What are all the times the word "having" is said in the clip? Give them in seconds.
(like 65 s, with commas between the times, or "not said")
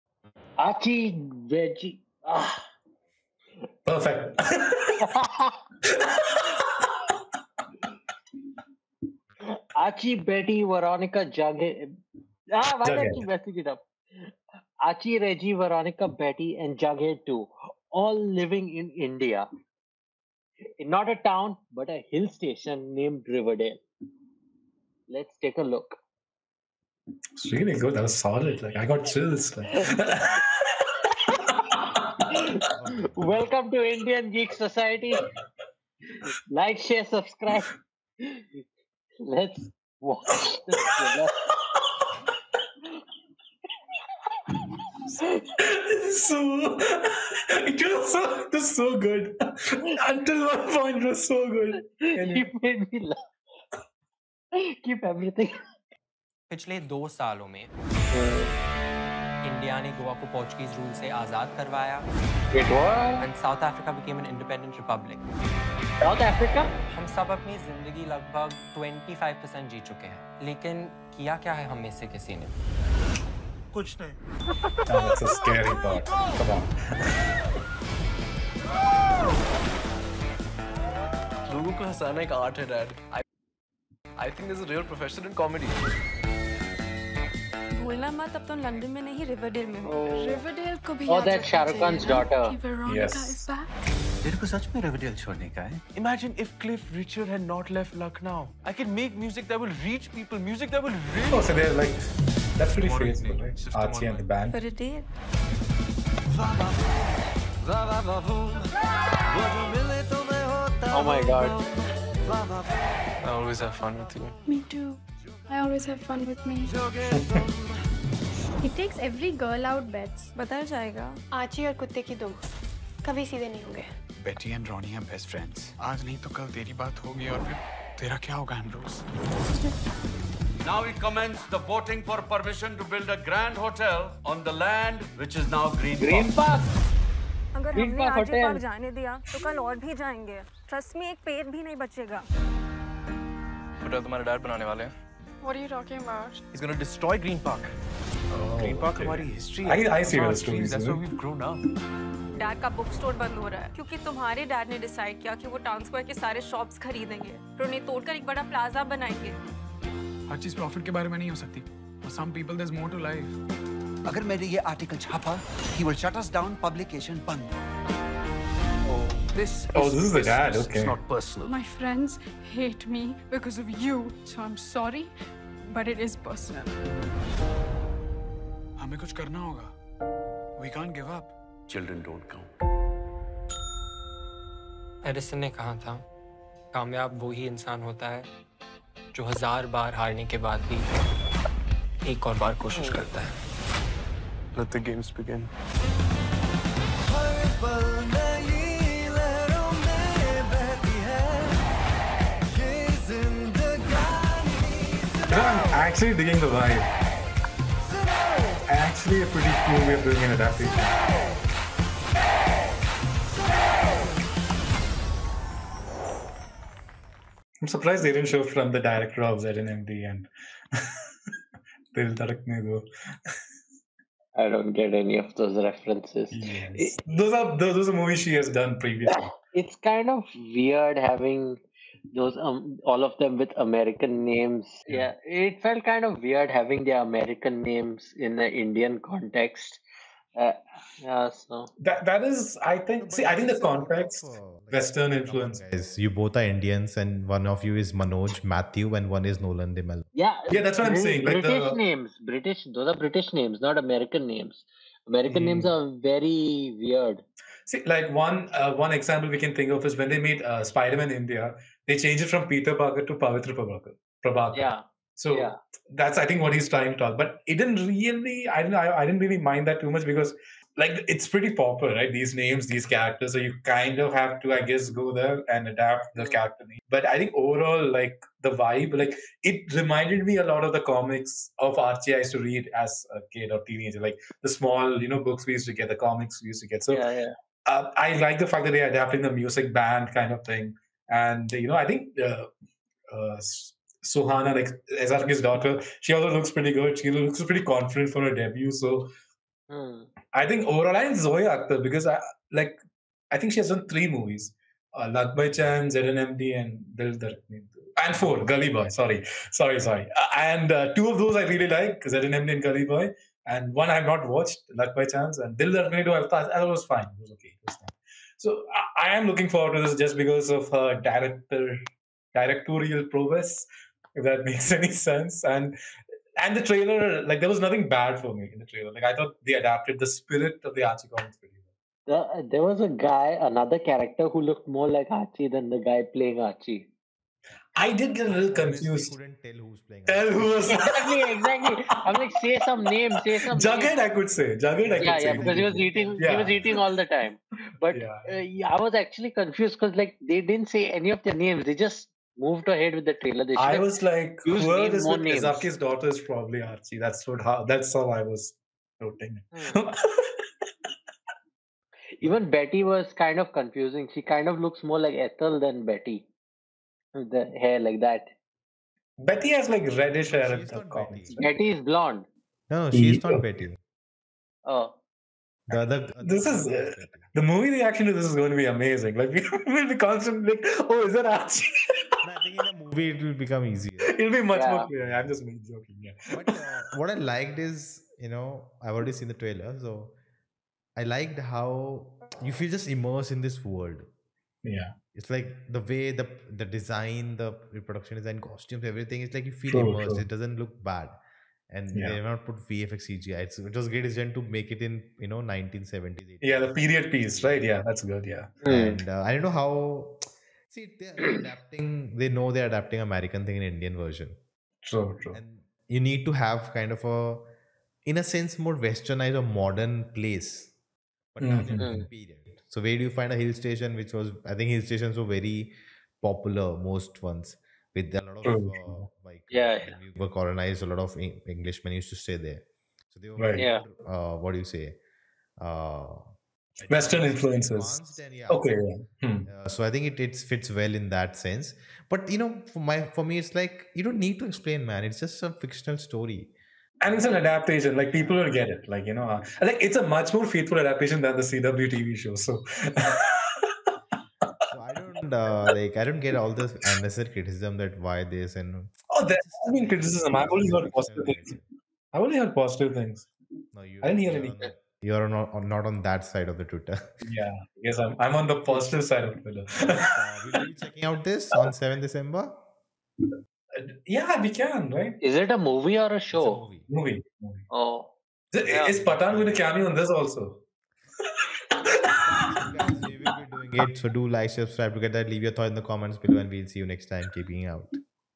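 230 s, 236 s.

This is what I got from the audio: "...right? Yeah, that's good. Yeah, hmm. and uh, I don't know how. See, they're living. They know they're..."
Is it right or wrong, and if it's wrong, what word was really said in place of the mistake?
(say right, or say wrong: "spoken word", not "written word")
wrong: "adapting", not "living".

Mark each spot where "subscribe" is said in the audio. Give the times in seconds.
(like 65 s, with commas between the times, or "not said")
37 s, 484 s.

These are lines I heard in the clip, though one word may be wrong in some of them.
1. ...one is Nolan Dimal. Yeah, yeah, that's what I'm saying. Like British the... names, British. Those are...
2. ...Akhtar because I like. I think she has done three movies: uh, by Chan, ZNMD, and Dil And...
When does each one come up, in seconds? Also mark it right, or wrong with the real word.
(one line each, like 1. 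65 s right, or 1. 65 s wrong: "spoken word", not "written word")
1. 249 s right
2. 301 s right.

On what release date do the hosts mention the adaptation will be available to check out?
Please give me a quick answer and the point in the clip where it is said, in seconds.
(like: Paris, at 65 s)
7 December, at 471 s.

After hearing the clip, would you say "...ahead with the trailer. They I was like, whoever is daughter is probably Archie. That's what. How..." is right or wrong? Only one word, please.
right.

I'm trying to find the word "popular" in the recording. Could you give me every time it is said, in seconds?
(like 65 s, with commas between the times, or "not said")
271 s, 426 s.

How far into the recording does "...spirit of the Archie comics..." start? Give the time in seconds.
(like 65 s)
330 s.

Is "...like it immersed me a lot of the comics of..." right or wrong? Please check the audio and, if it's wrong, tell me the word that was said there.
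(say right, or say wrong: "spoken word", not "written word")
wrong: "reminded", not "immersed".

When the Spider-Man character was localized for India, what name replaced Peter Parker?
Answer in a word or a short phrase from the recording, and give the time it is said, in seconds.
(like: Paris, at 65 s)
Pavitra Prabhakar, at 263 s.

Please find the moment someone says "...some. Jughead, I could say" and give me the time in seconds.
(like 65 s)
343 s.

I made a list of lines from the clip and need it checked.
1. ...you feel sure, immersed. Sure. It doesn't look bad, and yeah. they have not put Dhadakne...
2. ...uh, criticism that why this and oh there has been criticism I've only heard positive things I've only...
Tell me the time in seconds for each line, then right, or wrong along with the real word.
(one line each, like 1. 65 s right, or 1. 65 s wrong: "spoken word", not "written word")
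1. 399 s wrong: "VFX", not "Dhadakne"
2. 457 s right.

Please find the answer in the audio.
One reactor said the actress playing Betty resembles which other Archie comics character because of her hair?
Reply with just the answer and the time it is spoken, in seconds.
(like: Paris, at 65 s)
Ethel, at 365 s.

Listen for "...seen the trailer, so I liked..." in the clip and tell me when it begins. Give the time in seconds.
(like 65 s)
389 s.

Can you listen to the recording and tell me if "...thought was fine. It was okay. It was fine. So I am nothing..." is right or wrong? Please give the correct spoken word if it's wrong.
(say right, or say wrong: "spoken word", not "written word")
wrong: "looking", not "nothing".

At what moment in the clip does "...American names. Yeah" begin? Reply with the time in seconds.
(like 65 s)
233 s.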